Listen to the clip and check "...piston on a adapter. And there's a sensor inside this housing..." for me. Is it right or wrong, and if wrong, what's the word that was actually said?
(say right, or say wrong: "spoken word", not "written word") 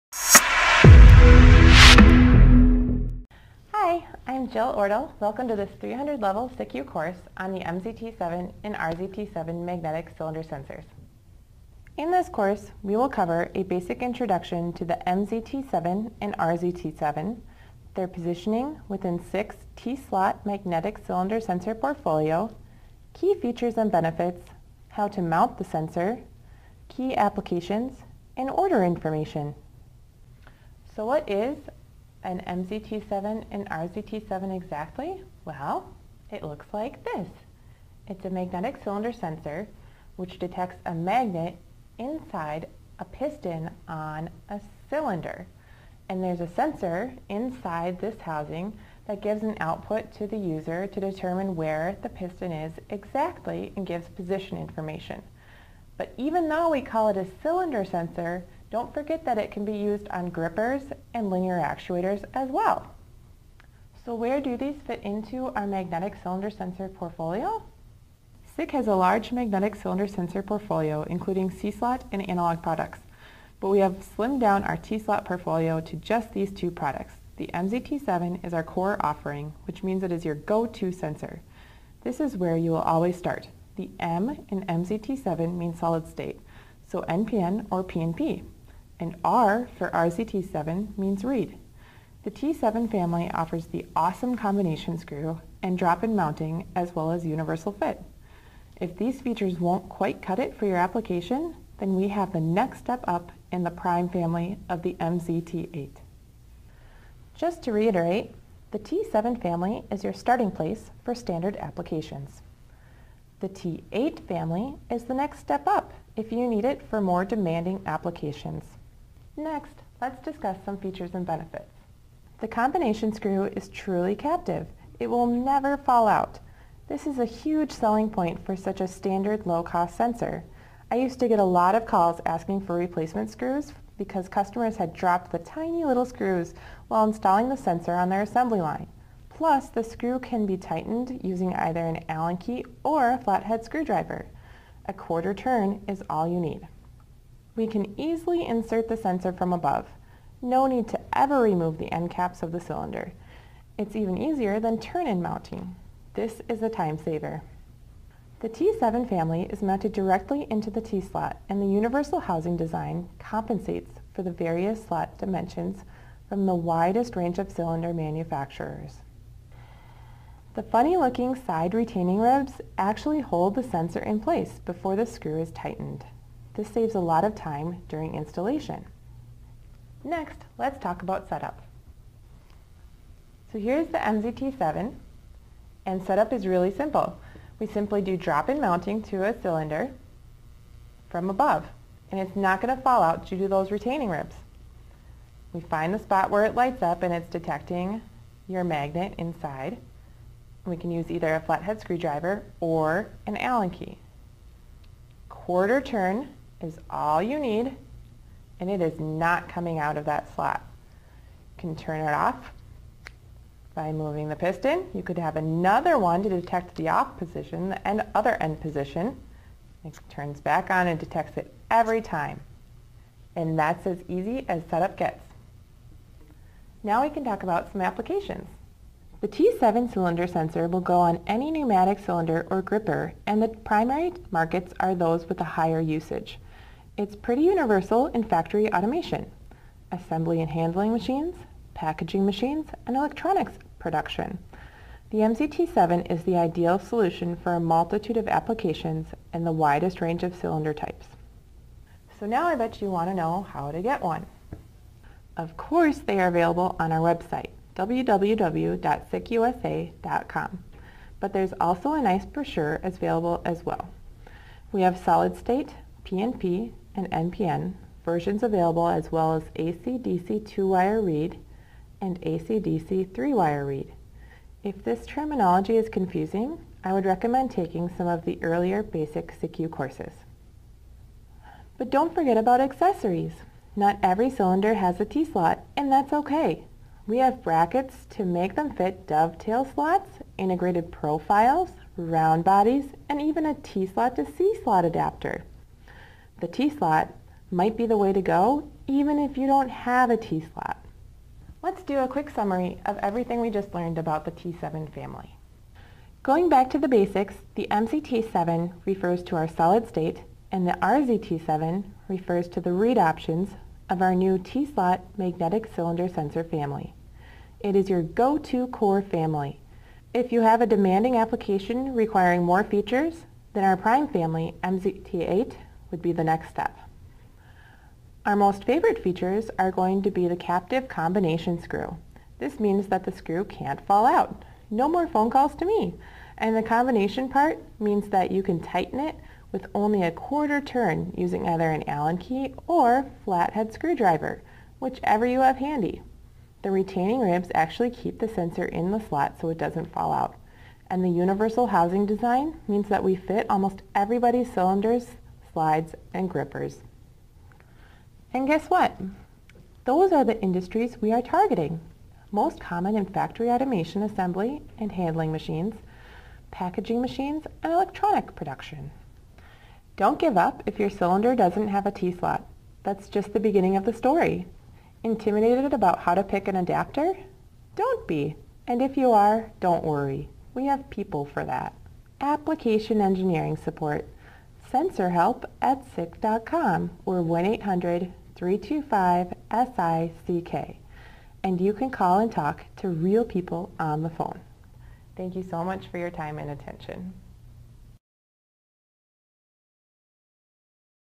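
wrong: "cylinder", not "adapter".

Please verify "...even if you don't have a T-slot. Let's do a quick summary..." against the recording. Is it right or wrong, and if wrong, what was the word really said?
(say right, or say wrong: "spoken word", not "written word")
right.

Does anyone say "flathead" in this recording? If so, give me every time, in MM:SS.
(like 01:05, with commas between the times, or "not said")
02:23, 03:21, 05:43.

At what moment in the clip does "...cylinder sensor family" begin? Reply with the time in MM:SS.
05:15.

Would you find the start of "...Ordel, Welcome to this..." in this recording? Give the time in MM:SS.
00:04.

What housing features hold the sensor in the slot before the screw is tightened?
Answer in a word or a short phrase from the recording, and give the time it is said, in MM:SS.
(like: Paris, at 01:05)
Side retaining ribs, at 02:51.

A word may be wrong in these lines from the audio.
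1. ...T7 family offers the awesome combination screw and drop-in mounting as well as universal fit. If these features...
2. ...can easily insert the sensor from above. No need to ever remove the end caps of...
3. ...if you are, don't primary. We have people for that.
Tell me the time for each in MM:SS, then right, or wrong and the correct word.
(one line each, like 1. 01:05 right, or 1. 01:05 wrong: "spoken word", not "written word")
1. 01:32 right
2. 02:27 right
3. 06:18 wrong: "worry", not "primary".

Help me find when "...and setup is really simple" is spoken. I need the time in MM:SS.
03:05.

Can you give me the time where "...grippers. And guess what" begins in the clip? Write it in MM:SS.
05:56.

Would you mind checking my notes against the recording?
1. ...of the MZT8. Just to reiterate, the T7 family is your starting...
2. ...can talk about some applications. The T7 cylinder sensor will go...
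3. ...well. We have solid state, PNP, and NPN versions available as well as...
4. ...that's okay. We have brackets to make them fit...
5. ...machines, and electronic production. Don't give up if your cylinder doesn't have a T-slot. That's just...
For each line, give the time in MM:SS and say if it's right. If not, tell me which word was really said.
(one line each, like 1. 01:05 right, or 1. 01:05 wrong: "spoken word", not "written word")
1. 01:44 right
2. 03:47 right
3. 04:23 right
4. 04:45 right
5. 06:07 right.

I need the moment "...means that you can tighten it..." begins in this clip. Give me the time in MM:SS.
05:37.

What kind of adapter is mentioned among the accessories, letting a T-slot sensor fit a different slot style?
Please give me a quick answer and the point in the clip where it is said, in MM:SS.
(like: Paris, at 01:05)
T-slot to C-slot, at 04:53.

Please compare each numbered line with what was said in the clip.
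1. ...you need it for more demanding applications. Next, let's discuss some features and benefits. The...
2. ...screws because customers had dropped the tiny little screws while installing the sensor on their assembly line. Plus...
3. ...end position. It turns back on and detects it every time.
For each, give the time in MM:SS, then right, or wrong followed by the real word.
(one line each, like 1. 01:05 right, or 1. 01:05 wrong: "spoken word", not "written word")
1. 01:56 right
2. 02:13 right
3. 03:38 right.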